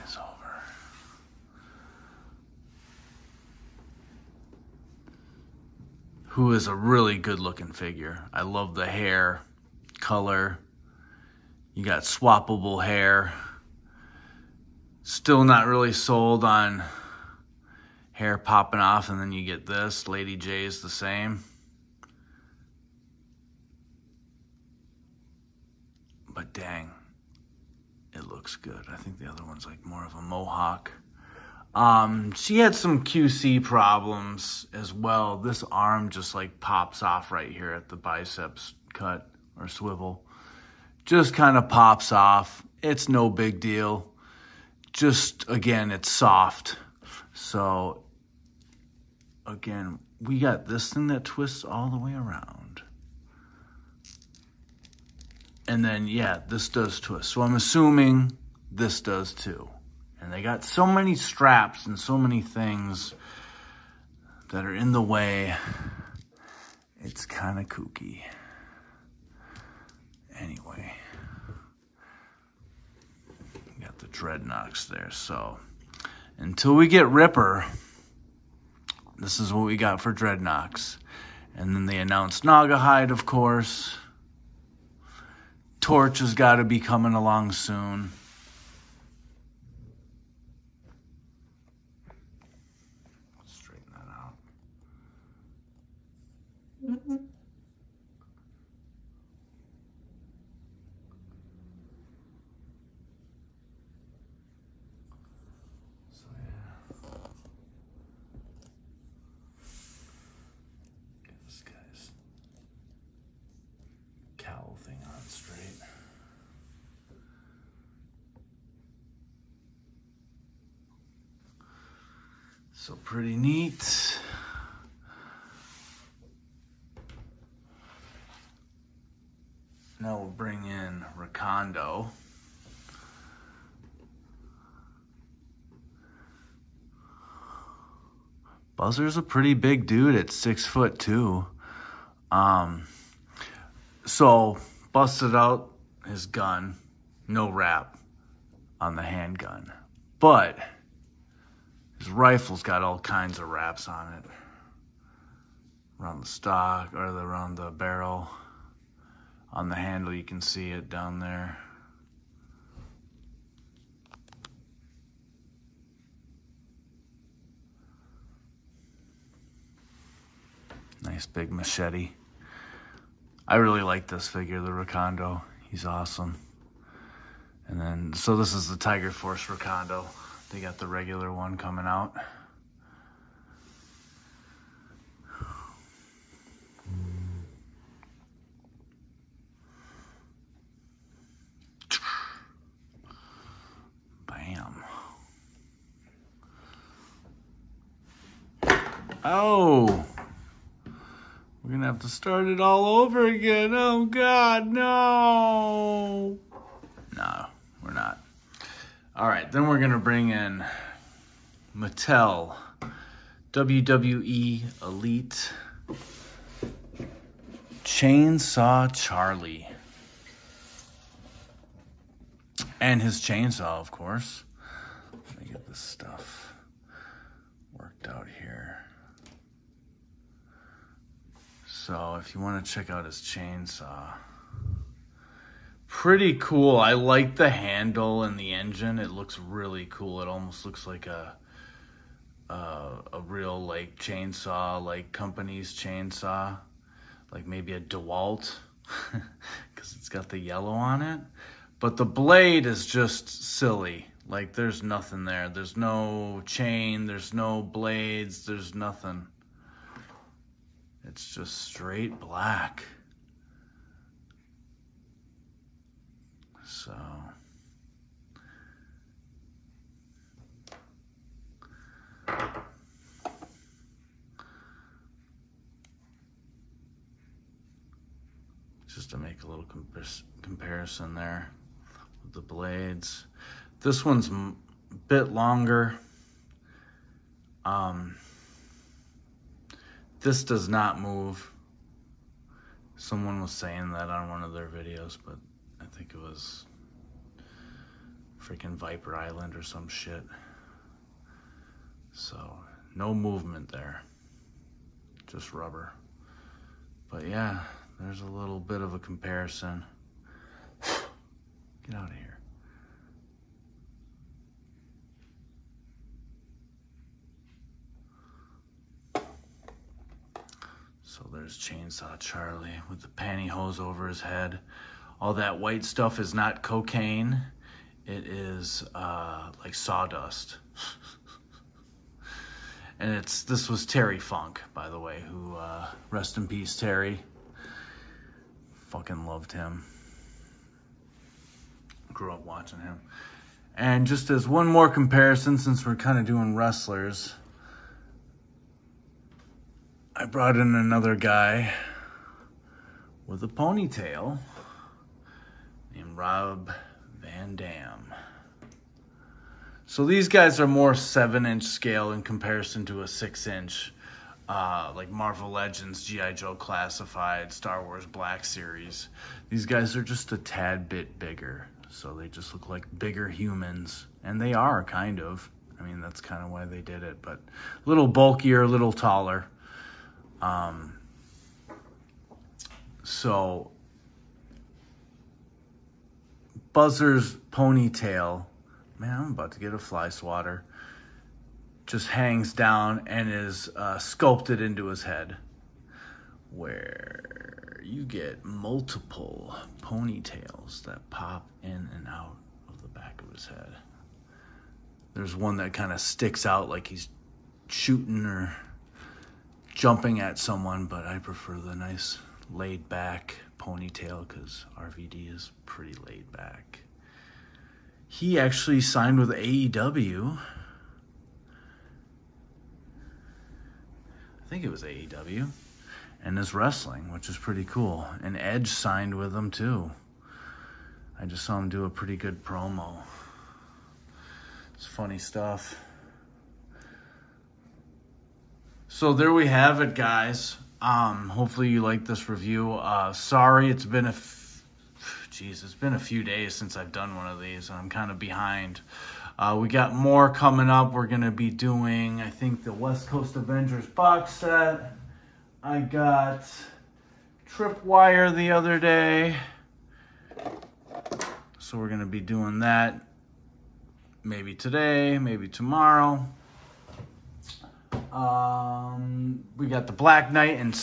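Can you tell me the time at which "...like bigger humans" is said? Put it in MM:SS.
06:12.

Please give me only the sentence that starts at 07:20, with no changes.
Um, hopefully you like this review.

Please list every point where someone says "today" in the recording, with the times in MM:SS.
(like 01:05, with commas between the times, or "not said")
07:44.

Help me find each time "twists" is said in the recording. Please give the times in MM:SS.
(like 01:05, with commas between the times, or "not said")
00:51, 00:57.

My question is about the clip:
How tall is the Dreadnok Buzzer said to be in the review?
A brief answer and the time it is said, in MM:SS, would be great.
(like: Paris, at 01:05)
6 foot 2, at 02:20.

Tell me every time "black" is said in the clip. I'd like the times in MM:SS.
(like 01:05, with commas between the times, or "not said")
04:22, 06:08, 07:49.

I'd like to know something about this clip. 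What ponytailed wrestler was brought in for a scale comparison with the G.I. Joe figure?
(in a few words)
Rob Van Dam.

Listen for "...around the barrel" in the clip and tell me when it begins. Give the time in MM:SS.
02:37.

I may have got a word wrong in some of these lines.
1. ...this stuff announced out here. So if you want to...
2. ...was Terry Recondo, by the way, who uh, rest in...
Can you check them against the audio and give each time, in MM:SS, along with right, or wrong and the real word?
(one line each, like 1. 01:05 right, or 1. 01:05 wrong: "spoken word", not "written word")
1. 03:45 wrong: "worked", not "announced"
2. 05:33 wrong: "Funk", not "Recondo".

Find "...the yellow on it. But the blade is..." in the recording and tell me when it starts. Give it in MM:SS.
04:10.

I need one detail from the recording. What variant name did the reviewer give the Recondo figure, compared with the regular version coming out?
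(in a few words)
Tiger Force.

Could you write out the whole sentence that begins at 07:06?
And is wrestling, which is pretty cool.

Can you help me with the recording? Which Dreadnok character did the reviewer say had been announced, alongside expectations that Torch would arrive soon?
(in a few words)
Gnawgahyde.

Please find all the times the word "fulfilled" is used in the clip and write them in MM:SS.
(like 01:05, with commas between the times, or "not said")
not said.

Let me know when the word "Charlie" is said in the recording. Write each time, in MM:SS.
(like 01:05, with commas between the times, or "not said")
03:38, 05:22.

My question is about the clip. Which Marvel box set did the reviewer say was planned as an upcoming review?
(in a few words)
West Coast Avengers.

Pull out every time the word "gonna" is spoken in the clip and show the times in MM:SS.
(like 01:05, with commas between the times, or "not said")
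07:31, 07:41.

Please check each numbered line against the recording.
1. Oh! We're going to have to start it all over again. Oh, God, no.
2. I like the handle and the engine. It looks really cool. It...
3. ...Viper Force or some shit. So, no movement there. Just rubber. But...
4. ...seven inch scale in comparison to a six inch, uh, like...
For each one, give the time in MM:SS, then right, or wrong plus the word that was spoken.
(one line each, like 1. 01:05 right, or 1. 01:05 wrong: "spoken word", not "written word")
1. 03:19 right
2. 03:56 right
3. 04:58 wrong: "Island", not "Force"
4. 06:00 right.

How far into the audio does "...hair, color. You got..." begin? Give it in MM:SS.
00:08.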